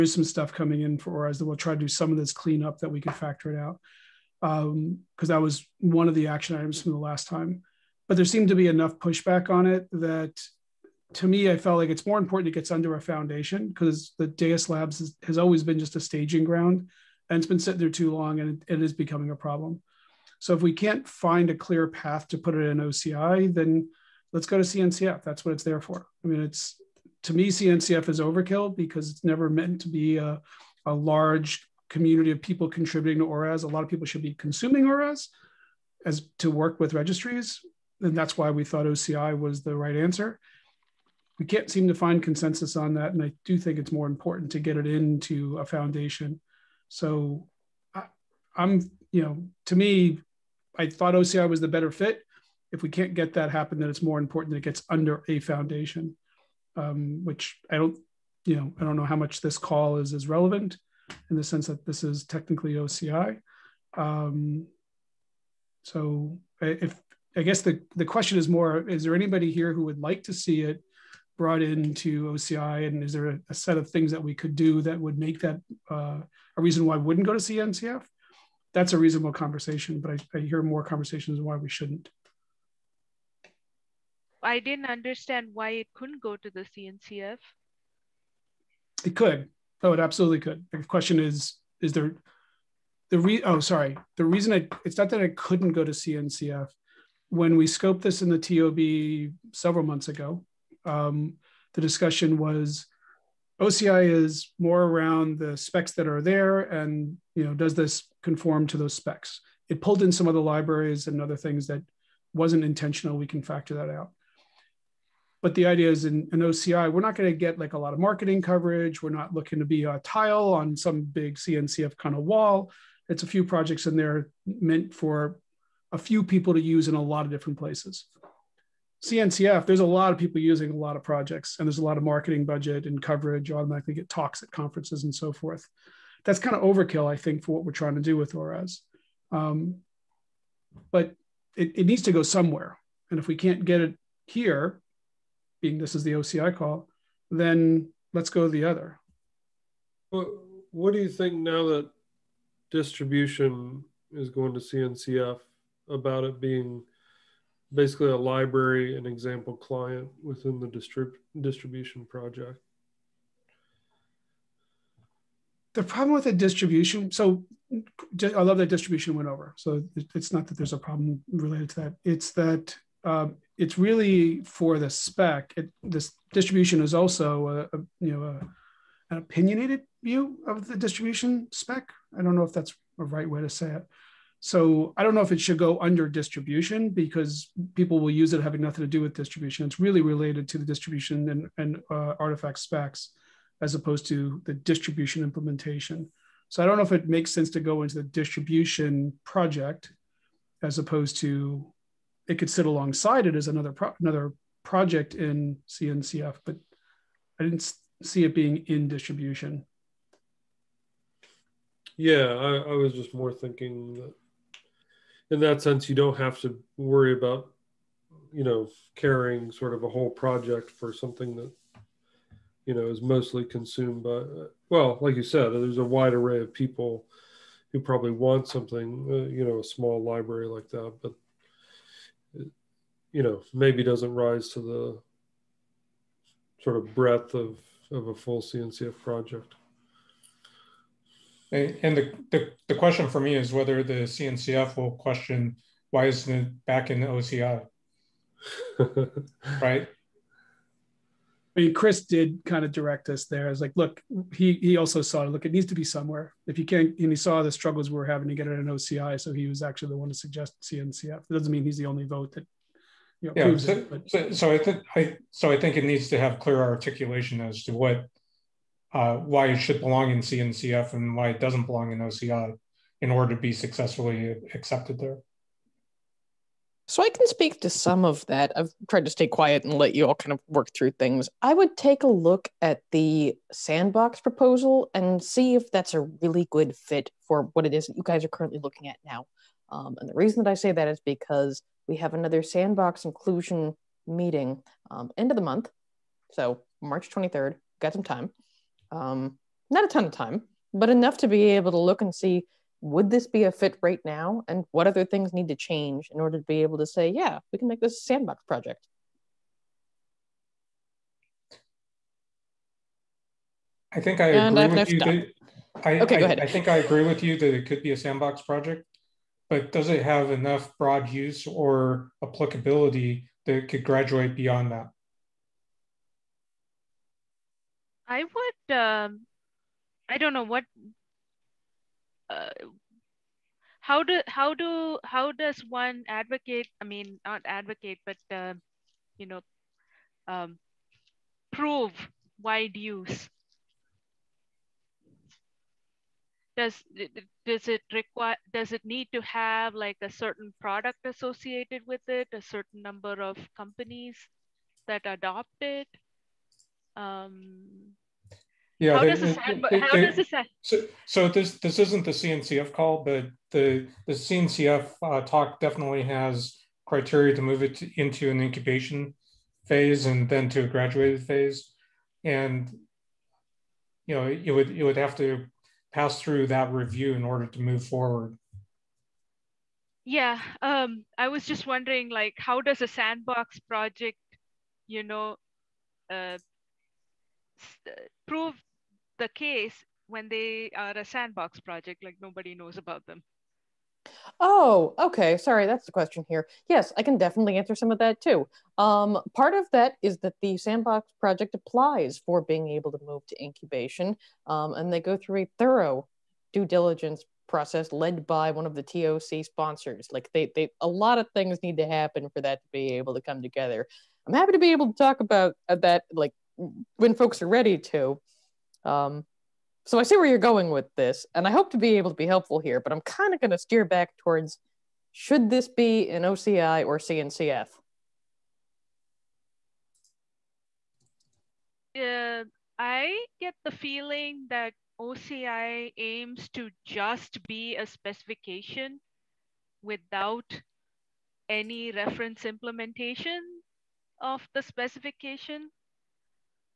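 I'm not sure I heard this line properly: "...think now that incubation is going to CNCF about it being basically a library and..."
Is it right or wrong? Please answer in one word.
wrong.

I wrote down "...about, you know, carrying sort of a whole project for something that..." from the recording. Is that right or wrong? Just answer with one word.
right.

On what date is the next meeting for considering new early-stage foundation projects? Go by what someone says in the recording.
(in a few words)
March 23rd.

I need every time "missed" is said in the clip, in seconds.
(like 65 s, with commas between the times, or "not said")
not said.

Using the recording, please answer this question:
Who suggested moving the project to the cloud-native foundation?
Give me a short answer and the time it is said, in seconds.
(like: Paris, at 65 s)
Chris, at 251 s.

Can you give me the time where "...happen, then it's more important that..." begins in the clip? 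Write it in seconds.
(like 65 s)
53 s.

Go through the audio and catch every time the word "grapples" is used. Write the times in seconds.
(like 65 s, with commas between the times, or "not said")
not said.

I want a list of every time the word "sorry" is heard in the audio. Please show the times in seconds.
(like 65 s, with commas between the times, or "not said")
93 s, 395 s.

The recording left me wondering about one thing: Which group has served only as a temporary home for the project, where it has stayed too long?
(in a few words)
Deis Labs.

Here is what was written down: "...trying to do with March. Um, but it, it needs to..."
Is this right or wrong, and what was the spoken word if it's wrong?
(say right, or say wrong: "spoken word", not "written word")
wrong: "ORAS", not "March".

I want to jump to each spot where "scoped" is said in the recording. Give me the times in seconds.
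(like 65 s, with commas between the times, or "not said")
97 s.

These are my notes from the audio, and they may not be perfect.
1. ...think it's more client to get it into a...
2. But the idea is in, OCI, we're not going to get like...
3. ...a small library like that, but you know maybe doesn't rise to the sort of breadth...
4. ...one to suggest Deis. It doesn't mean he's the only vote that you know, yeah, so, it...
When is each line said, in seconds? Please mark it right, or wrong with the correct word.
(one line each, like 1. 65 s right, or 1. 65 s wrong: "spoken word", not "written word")
1. 43 s wrong: "important", not "client"
2. 115 s right
3. 229 s right
4. 259 s wrong: "CNCF", not "Deis".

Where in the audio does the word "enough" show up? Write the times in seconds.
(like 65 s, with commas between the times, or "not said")
8 s, 300 s, 320 s.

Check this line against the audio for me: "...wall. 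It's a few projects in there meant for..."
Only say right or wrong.
right.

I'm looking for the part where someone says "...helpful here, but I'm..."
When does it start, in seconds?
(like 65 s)
422 s.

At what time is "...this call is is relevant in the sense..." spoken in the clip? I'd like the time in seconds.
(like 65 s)
59 s.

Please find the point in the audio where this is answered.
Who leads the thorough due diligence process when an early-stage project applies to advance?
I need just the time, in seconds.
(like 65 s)
408 s.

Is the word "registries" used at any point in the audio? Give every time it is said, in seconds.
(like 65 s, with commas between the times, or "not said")
36 s.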